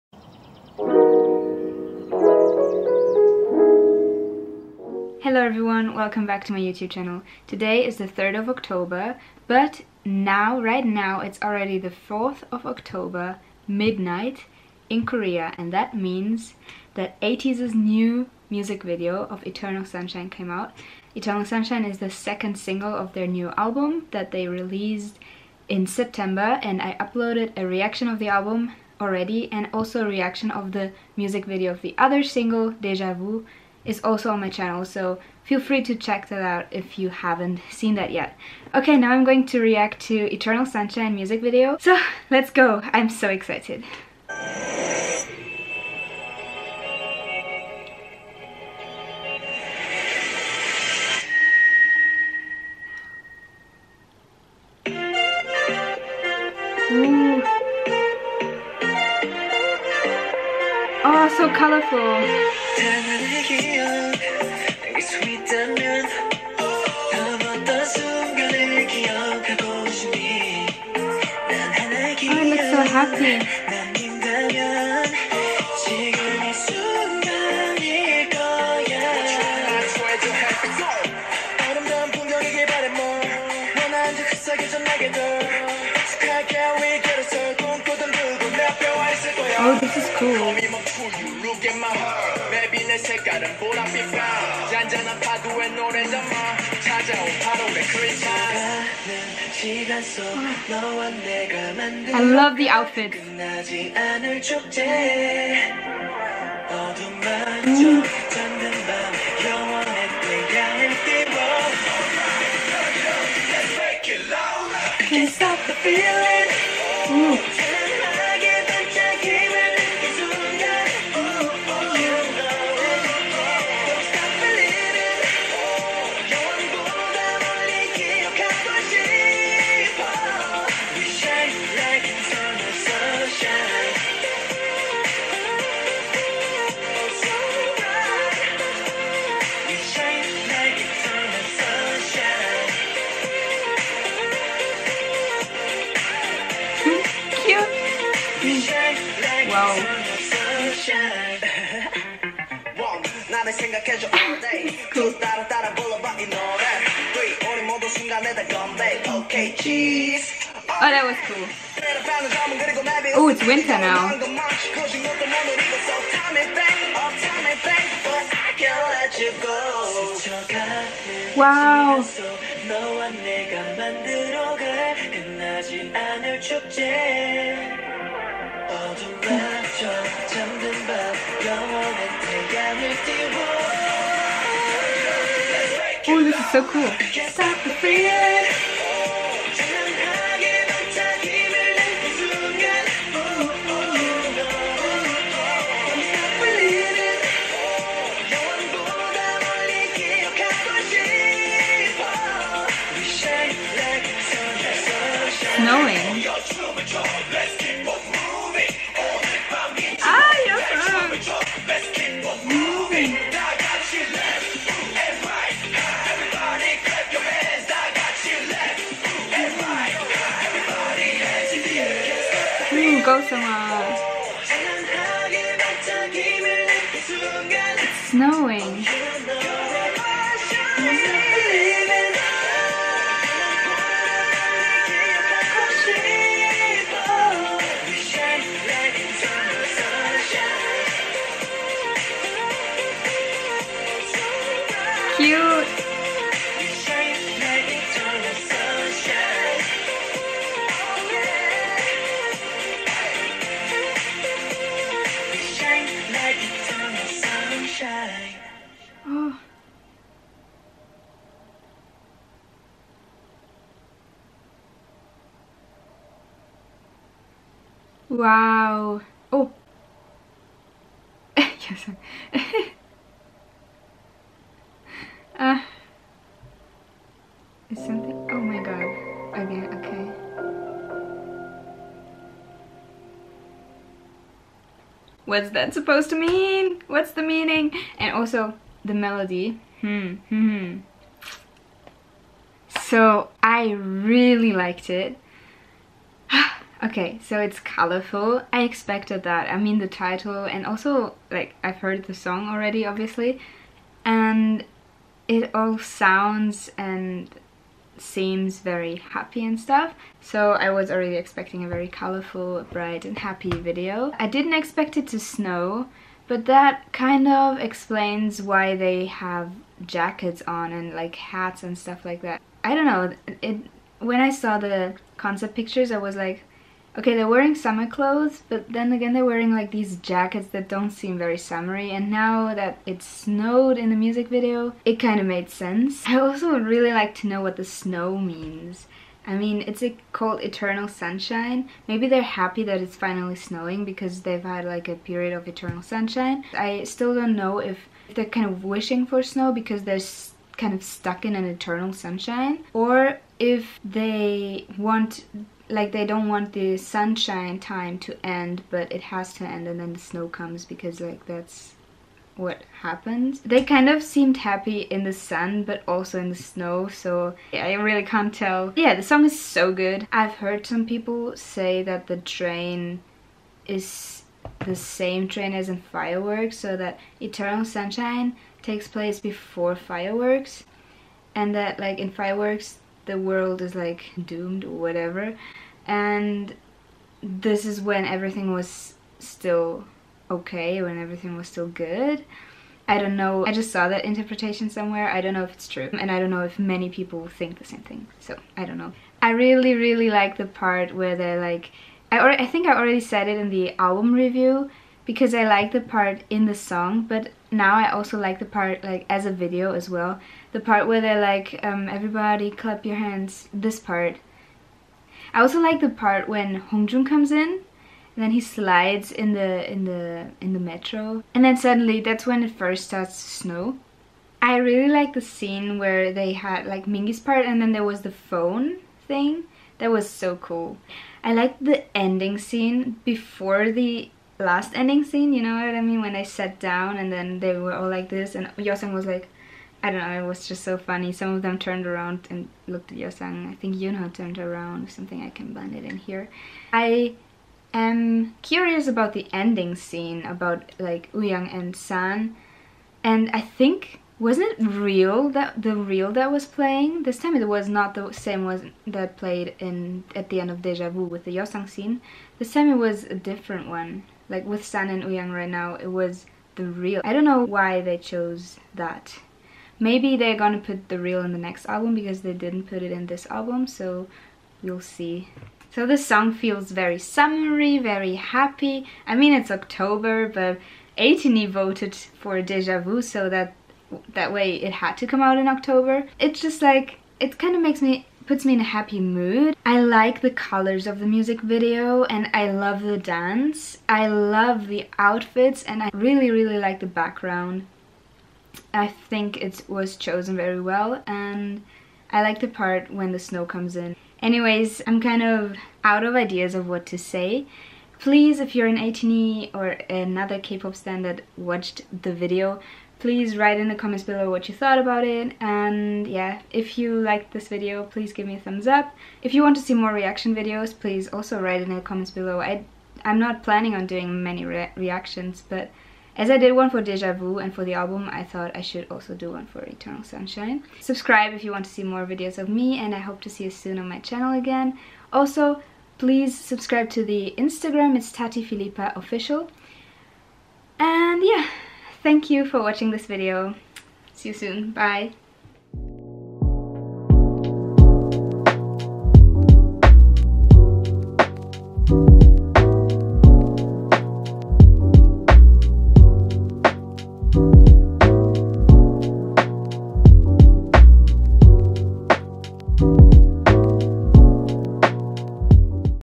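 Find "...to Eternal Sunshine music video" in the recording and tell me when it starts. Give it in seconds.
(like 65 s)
40 s.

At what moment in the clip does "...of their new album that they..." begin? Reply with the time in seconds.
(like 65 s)
22 s.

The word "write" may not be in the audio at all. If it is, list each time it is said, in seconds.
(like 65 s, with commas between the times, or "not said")
513 s, 521 s.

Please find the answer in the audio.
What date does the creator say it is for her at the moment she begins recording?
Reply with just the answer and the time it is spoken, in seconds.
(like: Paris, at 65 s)
3 October, at 8 s.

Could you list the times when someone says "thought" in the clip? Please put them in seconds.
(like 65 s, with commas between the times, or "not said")
514 s, 528 s.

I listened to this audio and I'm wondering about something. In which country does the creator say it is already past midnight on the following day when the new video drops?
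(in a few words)
Korea.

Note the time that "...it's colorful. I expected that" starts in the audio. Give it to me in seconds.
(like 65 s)
297 s.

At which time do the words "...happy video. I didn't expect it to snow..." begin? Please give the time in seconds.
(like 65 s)
313 s.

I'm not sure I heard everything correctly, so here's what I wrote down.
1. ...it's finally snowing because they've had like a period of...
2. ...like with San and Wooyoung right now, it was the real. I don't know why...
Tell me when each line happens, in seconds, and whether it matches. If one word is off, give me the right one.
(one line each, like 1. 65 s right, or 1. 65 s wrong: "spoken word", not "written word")
1. 342 s right
2. 464 s right.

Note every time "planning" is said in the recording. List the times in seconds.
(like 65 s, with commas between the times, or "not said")
523 s.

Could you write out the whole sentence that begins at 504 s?
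Anyways, I'm kind of out of ideas of what to say.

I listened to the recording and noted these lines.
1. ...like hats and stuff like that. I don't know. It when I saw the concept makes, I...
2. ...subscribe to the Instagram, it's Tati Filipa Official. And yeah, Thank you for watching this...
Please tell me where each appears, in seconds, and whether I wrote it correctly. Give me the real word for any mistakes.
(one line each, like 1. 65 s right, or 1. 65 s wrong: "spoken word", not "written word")
1. 320 s wrong: "pictures", not "makes"
2. 536 s right.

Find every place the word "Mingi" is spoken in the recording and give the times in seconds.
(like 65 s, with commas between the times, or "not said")
426 s.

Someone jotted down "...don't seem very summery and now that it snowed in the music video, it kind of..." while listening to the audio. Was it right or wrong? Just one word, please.
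right.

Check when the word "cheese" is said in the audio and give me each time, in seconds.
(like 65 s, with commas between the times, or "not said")
159 s.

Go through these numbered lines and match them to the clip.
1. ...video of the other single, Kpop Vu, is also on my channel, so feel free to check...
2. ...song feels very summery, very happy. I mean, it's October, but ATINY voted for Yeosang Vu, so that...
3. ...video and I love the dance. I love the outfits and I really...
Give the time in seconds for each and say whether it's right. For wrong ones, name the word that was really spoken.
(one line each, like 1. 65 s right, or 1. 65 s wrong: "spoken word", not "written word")
1. 31 s wrong: "Deja", not "Kpop"
2. 476 s wrong: "Deja", not "Yeosang"
3. 491 s right.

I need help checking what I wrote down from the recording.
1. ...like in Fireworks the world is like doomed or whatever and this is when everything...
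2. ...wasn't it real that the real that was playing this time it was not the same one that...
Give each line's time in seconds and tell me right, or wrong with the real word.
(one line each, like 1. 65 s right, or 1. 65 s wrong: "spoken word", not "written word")
1. 381 s right
2. 454 s right.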